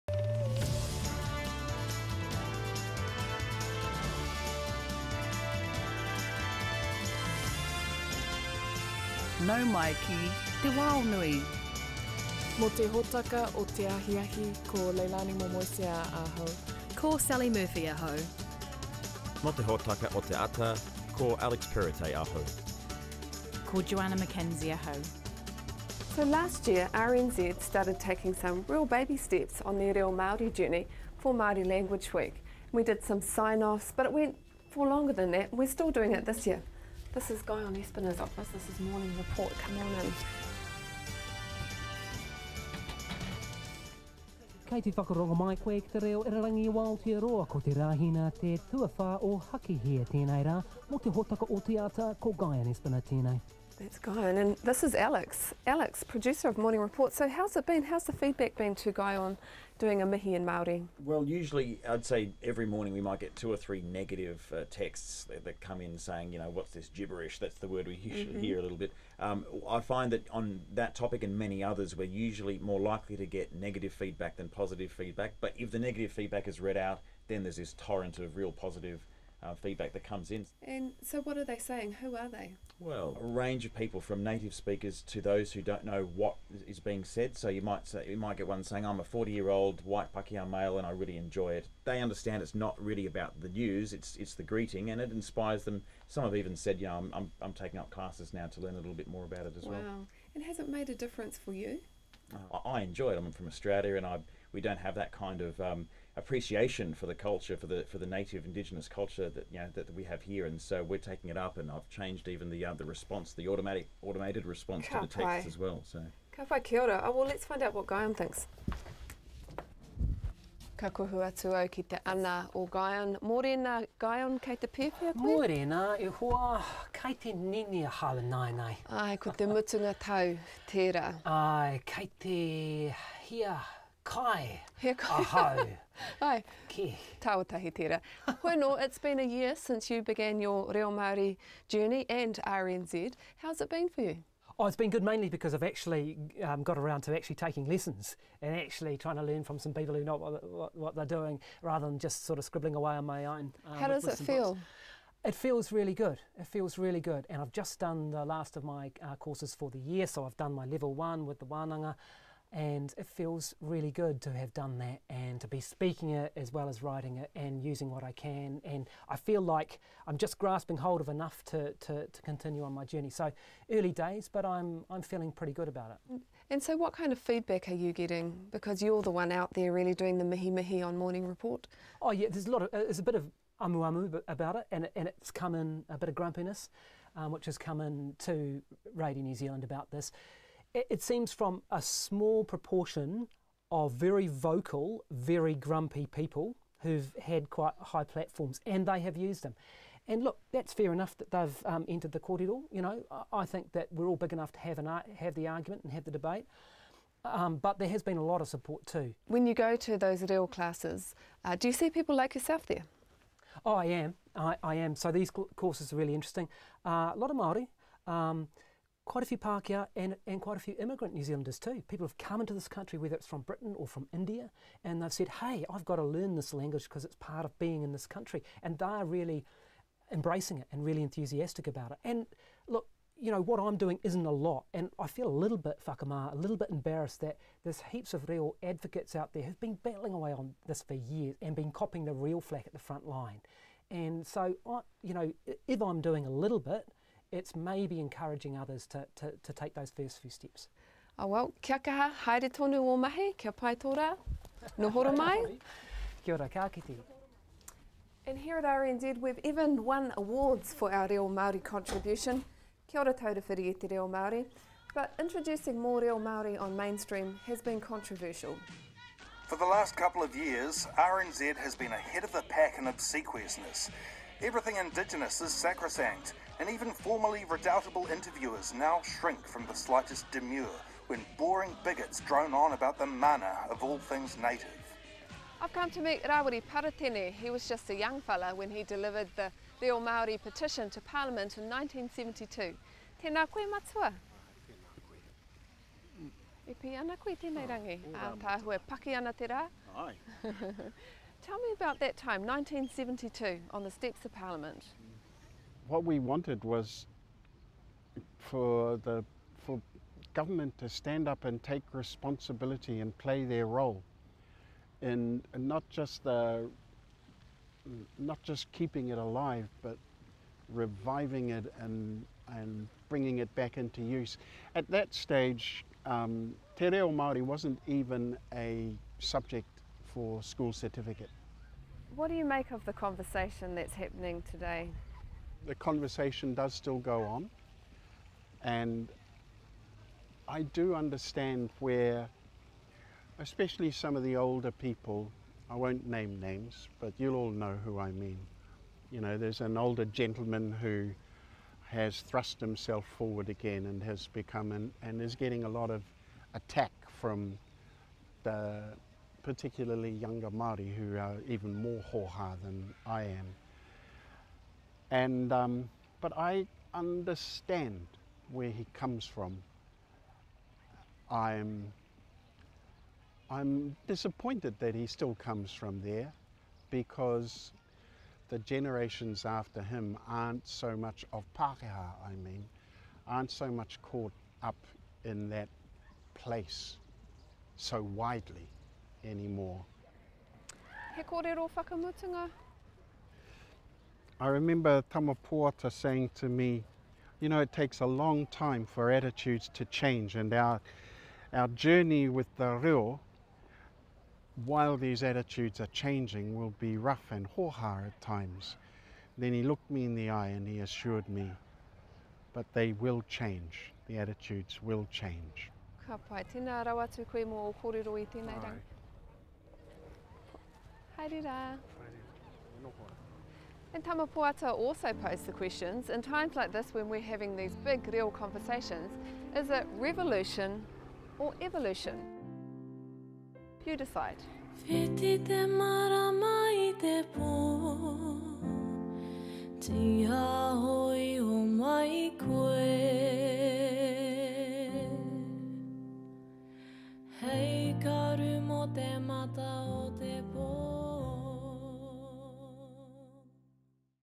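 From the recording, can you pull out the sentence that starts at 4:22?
Kia ora Taura Whiri e te Reo Māori.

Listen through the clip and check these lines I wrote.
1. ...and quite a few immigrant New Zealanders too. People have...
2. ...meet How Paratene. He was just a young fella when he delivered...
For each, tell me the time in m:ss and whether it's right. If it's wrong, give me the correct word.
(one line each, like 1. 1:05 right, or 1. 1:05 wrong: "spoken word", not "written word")
1. 3:40 right
2. 4:46 wrong: "Rawiri", not "How".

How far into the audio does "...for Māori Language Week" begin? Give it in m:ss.
0:31.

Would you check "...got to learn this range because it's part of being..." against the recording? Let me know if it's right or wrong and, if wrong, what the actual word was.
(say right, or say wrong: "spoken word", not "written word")
wrong: "language", not "range".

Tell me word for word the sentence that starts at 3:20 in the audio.
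And look, that's fair enough that they've um, entered the corridor.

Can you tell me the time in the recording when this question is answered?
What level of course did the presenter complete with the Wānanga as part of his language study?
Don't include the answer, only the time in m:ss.
2:40.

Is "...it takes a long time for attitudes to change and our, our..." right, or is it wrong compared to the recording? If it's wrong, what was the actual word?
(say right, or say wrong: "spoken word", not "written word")
right.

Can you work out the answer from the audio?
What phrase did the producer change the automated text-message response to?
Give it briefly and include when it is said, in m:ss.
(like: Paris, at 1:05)
Ka pai kia ora, at 1:56.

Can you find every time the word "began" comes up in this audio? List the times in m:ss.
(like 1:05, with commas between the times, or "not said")
2:20.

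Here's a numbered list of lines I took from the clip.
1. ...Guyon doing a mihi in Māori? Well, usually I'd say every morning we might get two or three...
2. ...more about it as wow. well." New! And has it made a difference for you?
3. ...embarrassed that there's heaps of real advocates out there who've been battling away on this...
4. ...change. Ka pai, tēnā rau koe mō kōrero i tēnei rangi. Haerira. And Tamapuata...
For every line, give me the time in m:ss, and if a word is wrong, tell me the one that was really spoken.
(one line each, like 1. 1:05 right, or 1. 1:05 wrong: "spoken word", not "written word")
1. 0:58 right
2. 1:39 wrong: "Wow", not "New"
3. 3:56 right
4. 6:55 right.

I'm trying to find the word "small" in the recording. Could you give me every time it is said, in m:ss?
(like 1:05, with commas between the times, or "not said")
3:11.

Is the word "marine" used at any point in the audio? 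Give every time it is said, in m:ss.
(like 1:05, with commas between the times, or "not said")
not said.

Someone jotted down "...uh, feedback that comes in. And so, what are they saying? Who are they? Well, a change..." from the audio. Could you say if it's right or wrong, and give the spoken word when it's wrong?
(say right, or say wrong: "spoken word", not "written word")
wrong: "range", not "change".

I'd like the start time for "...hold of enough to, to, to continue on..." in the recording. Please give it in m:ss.
2:50.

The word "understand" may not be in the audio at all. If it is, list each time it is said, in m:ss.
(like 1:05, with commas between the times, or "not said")
1:32, 5:40, 6:06.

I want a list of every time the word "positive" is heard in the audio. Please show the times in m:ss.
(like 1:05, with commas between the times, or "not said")
1:14, 1:18.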